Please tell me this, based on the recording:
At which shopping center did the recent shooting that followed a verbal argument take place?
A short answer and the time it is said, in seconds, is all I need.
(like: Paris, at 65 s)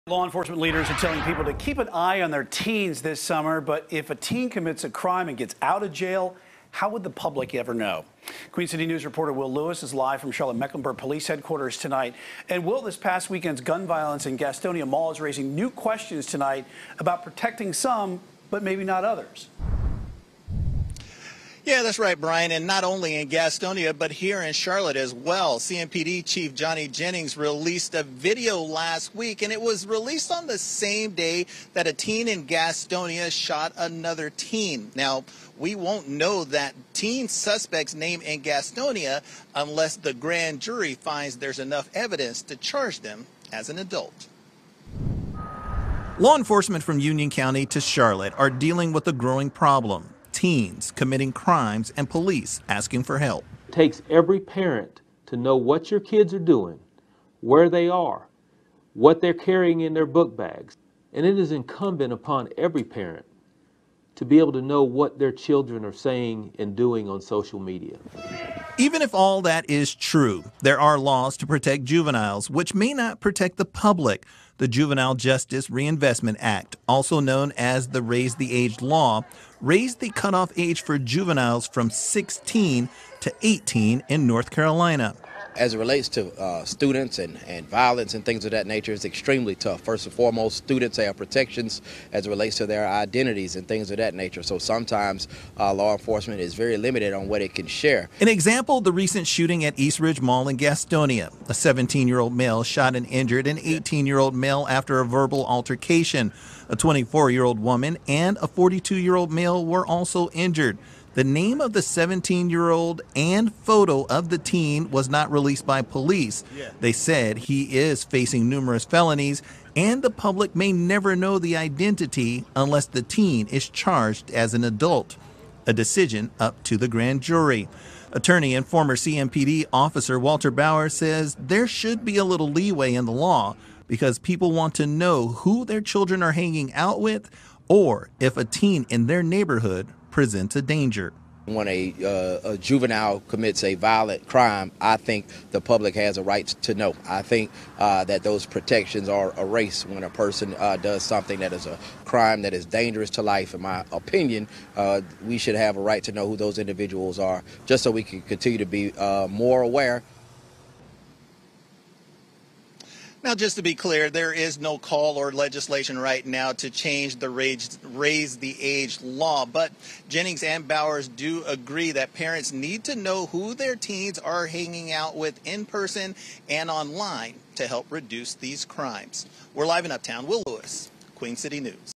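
East Ridge Mall, at 99 s.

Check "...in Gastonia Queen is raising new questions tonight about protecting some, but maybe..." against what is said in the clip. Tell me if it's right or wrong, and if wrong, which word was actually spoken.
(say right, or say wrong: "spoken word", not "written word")
wrong: "Mall", not "Queen".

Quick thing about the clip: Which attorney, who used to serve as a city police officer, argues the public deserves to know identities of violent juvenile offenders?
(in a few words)
Walter Bowers.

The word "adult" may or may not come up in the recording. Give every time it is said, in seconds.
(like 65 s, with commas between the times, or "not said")
43 s, 124 s.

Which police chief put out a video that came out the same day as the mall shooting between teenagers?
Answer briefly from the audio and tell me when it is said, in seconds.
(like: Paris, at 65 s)
Johnny Jennings, at 26 s.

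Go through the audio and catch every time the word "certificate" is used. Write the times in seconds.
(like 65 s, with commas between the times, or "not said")
not said.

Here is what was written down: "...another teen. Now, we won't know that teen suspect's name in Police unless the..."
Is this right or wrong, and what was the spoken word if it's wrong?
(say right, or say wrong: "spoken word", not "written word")
wrong: "Gastonia", not "Police".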